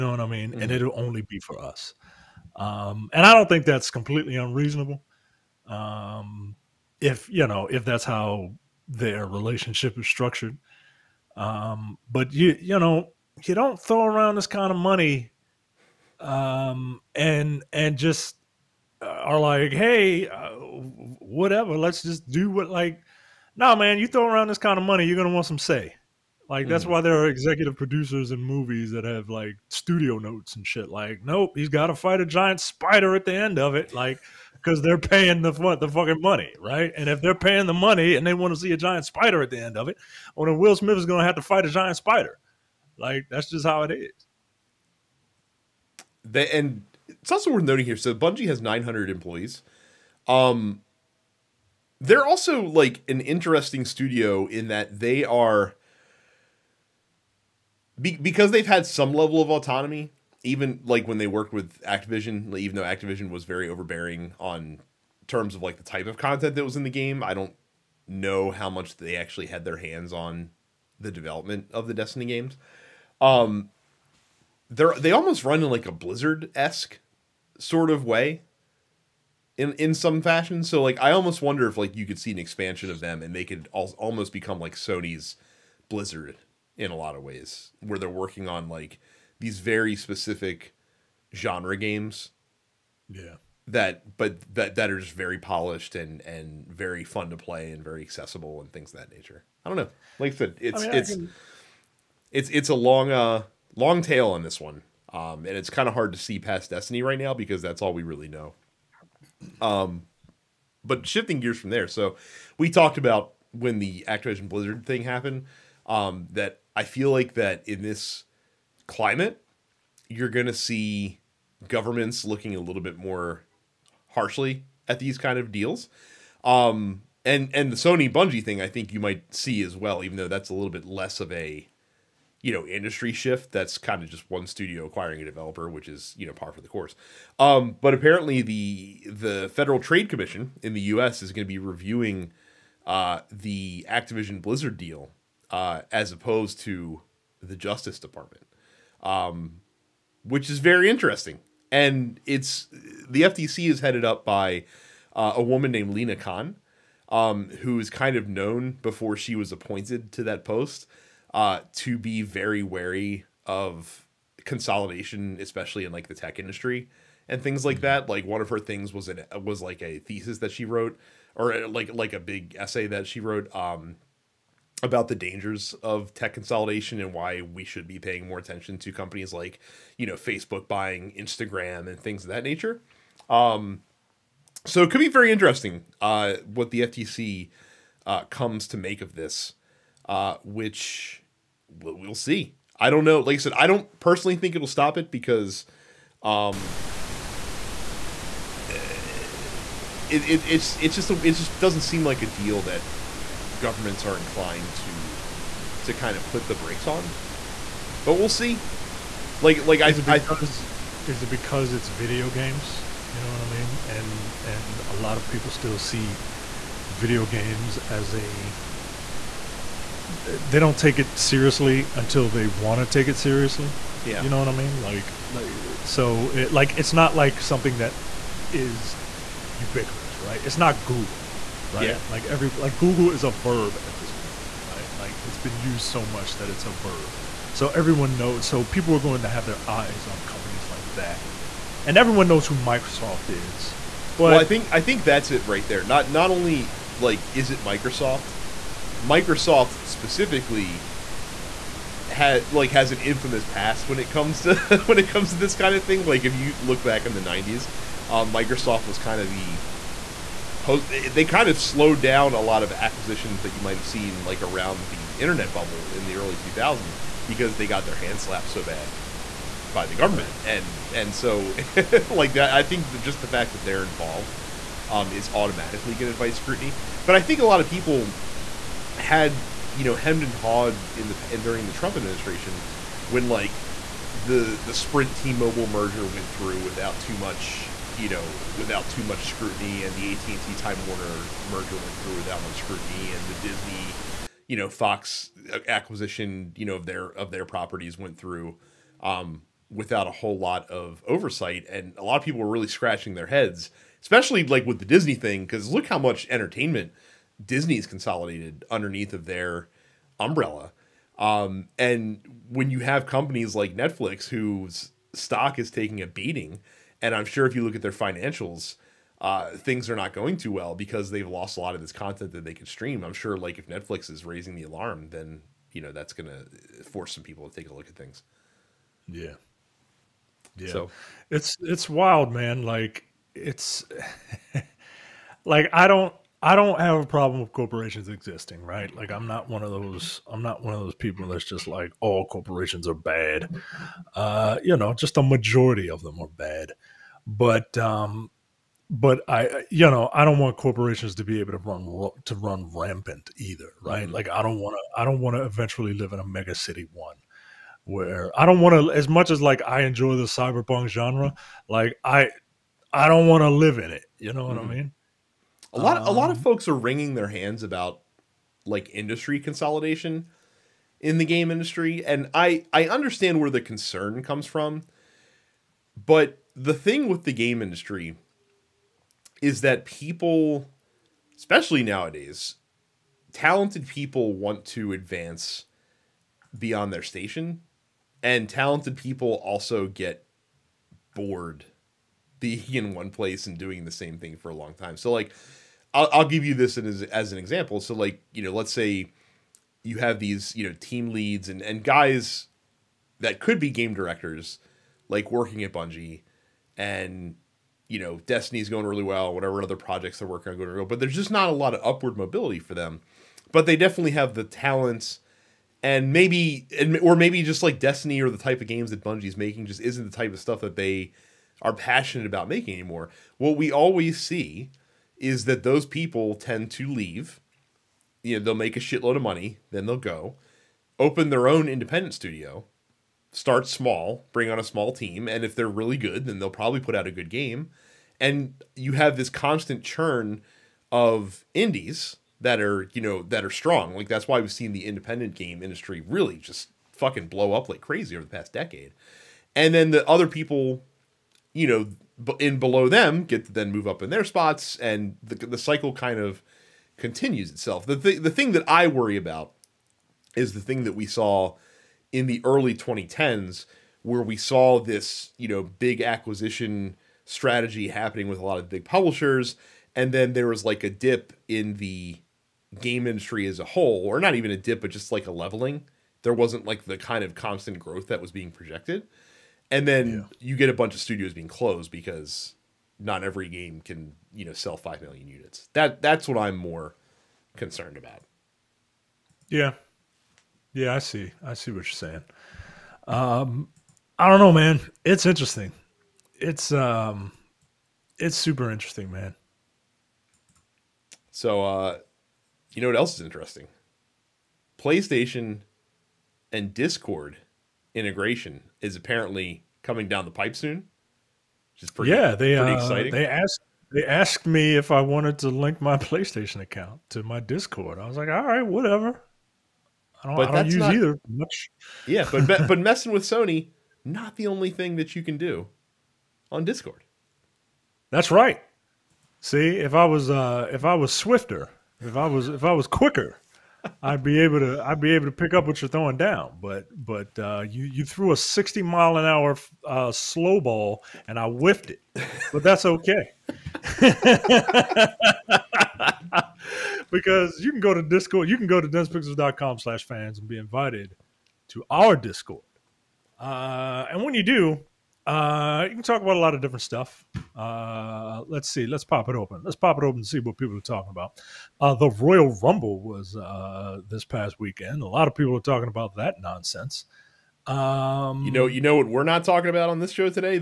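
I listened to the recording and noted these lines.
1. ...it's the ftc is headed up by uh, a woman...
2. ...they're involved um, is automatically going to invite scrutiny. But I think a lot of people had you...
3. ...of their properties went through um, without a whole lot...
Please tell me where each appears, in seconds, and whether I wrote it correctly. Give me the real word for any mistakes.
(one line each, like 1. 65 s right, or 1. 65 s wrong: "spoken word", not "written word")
1. 152 s right
2. 273 s right
3. 297 s right.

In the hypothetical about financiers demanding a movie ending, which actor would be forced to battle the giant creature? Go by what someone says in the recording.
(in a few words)
Will Smith.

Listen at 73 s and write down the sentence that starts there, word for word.
Um, they're they almost run in like a blizzard esque sort of way.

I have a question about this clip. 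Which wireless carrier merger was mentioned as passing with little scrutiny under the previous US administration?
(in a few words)
Sprint T-Mobile.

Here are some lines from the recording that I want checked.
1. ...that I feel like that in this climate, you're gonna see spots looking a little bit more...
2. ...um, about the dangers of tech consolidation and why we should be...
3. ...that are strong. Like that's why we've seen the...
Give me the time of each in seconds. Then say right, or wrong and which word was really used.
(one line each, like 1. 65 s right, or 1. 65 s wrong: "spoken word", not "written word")
1. 116 s wrong: "governments", not "spots"
2. 173 s right
3. 443 s right.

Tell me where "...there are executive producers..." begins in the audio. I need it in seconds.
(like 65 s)
27 s.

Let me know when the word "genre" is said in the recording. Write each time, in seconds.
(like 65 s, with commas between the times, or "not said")
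91 s, 360 s.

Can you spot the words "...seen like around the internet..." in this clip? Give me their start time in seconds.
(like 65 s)
263 s.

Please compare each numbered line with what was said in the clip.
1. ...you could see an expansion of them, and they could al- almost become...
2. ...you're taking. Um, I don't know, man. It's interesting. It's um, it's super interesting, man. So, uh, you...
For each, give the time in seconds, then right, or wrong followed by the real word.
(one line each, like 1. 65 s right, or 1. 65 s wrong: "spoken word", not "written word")
1. 81 s right
2. 491 s wrong: "saying", not "taking".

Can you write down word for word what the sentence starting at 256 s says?
Like if you look back in the '90s, um, Microsoft was kind of the post.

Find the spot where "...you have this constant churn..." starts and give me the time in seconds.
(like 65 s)
438 s.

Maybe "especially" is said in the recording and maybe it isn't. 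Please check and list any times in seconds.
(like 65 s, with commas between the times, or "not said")
165 s, 304 s, 381 s.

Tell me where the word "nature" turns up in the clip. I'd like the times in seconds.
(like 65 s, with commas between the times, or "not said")
99 s, 182 s.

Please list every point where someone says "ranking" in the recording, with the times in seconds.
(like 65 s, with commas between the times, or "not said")
not said.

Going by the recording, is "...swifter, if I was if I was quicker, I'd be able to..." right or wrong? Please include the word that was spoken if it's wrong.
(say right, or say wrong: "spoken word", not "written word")
right.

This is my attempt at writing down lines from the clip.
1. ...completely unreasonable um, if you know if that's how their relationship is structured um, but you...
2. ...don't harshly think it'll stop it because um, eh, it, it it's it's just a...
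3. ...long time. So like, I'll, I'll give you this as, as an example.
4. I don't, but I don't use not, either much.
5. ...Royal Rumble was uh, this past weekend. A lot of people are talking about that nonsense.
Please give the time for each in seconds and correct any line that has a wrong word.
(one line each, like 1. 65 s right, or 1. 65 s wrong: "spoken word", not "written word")
1. 3 s right
2. 193 s wrong: "personally", not "harshly"
3. 394 s right
4. 520 s right
5. 562 s right.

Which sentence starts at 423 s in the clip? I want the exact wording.
What we always see is that those people tend to leave.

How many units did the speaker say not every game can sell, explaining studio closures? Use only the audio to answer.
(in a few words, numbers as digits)
5 million.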